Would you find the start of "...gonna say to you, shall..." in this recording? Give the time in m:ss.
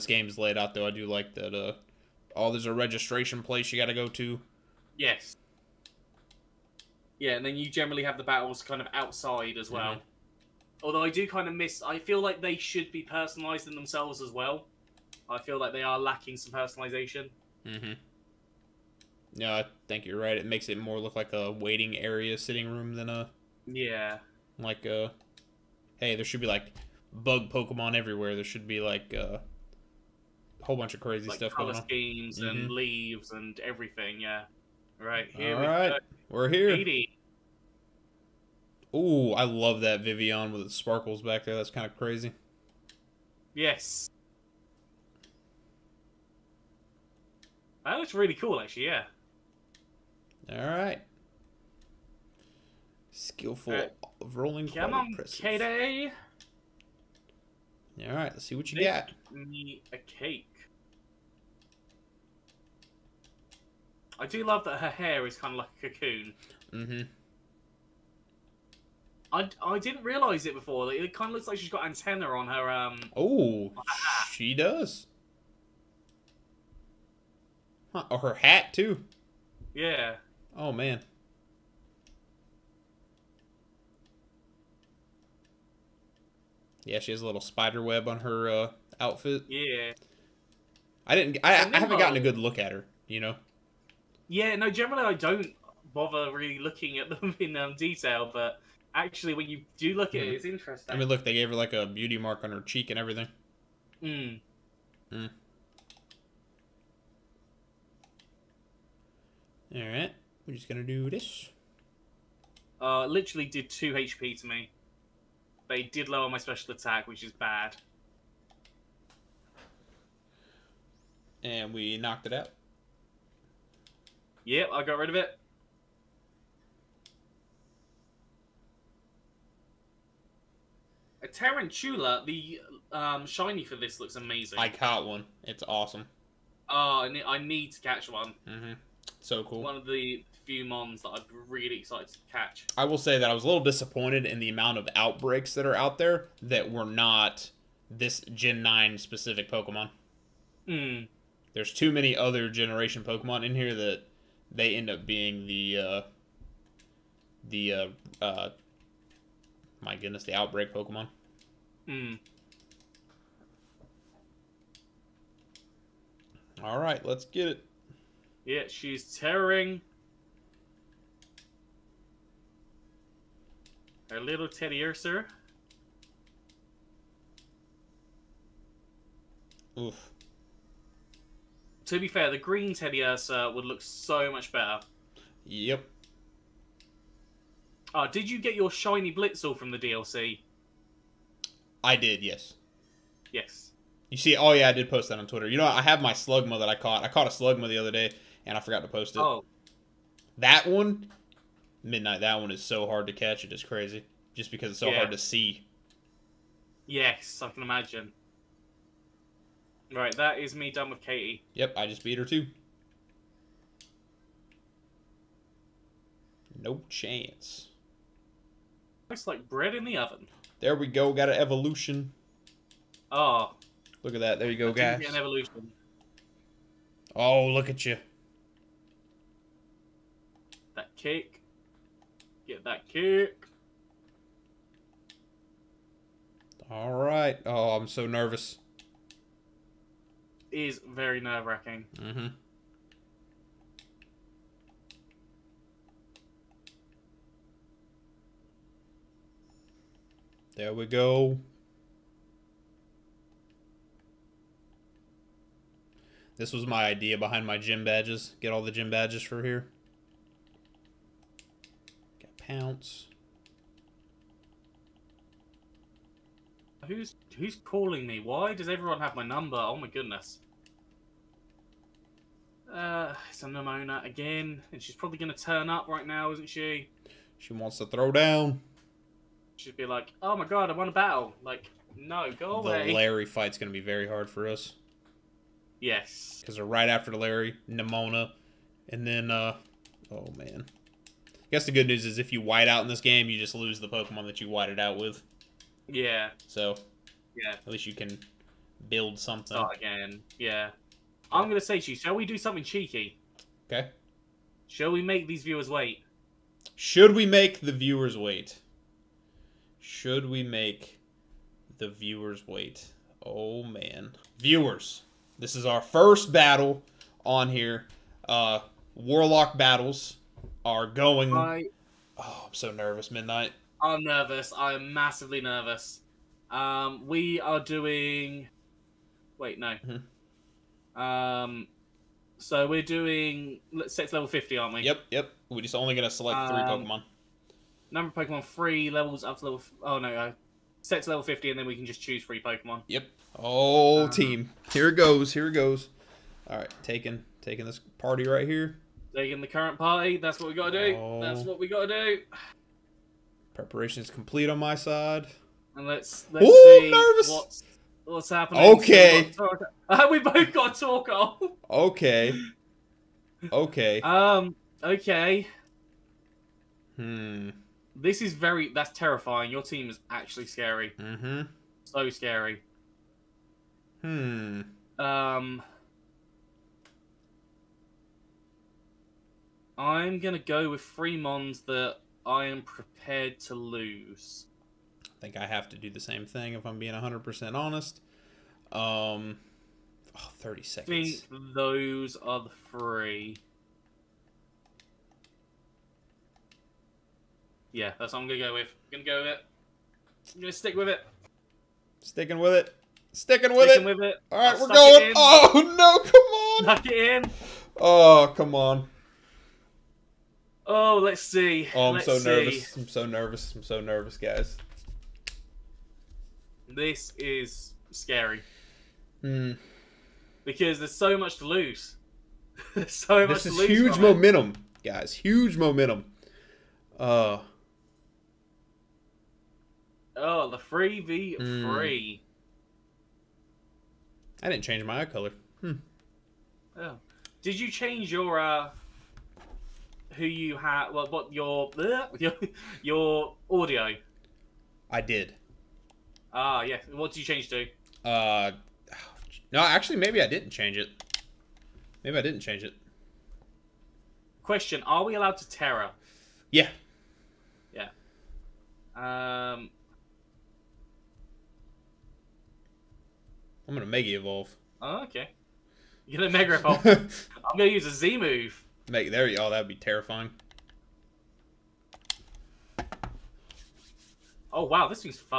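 5:01.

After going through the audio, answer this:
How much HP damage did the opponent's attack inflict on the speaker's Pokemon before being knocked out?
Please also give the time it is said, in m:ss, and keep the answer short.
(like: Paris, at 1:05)
2, at 1:53.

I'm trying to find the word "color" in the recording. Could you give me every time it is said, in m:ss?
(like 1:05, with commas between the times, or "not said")
0:31, 7:15.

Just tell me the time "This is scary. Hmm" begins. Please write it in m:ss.
6:56.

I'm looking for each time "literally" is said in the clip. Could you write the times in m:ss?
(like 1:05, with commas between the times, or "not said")
1:53.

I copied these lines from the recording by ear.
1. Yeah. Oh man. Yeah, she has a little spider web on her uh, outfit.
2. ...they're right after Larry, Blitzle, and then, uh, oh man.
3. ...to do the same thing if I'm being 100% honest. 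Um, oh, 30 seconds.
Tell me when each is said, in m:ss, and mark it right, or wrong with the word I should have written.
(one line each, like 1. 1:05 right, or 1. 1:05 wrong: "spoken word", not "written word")
1. 1:19 right
2. 4:46 wrong: "Nemona", not "Blitzle"
3. 6:25 right.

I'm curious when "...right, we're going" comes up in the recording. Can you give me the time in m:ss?
6:44.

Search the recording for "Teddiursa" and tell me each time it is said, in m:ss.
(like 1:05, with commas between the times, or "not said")
2:54, 3:02.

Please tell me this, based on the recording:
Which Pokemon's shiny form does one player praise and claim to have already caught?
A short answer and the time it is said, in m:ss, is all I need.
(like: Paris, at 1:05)
Tarantula, at 2:11.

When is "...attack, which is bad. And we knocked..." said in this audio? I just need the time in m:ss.
1:56.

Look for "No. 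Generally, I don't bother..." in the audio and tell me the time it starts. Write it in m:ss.
1:34.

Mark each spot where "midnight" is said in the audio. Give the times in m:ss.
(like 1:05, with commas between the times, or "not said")
3:21, 5:23.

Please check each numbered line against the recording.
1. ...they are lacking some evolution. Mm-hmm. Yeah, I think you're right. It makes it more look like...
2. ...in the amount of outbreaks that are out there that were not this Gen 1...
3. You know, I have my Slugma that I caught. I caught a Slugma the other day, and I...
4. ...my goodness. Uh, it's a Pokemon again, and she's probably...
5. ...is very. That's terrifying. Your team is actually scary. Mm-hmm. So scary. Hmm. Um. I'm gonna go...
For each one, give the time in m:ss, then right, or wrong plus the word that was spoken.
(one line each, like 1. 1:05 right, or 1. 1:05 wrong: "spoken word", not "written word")
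1. 0:15 wrong: "personalization", not "evolution"
2. 2:24 wrong: "9", not "1"
3. 3:15 right
4. 4:29 wrong: "Nemona", not "Pokemon"
5. 6:08 right.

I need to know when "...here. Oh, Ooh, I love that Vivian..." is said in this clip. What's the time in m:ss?
0:36.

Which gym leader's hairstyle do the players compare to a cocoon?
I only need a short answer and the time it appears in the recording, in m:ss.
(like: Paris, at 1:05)
Katy, at 3:30.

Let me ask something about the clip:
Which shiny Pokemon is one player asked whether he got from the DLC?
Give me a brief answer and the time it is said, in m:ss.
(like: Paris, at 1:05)
Blitzle, at 3:09.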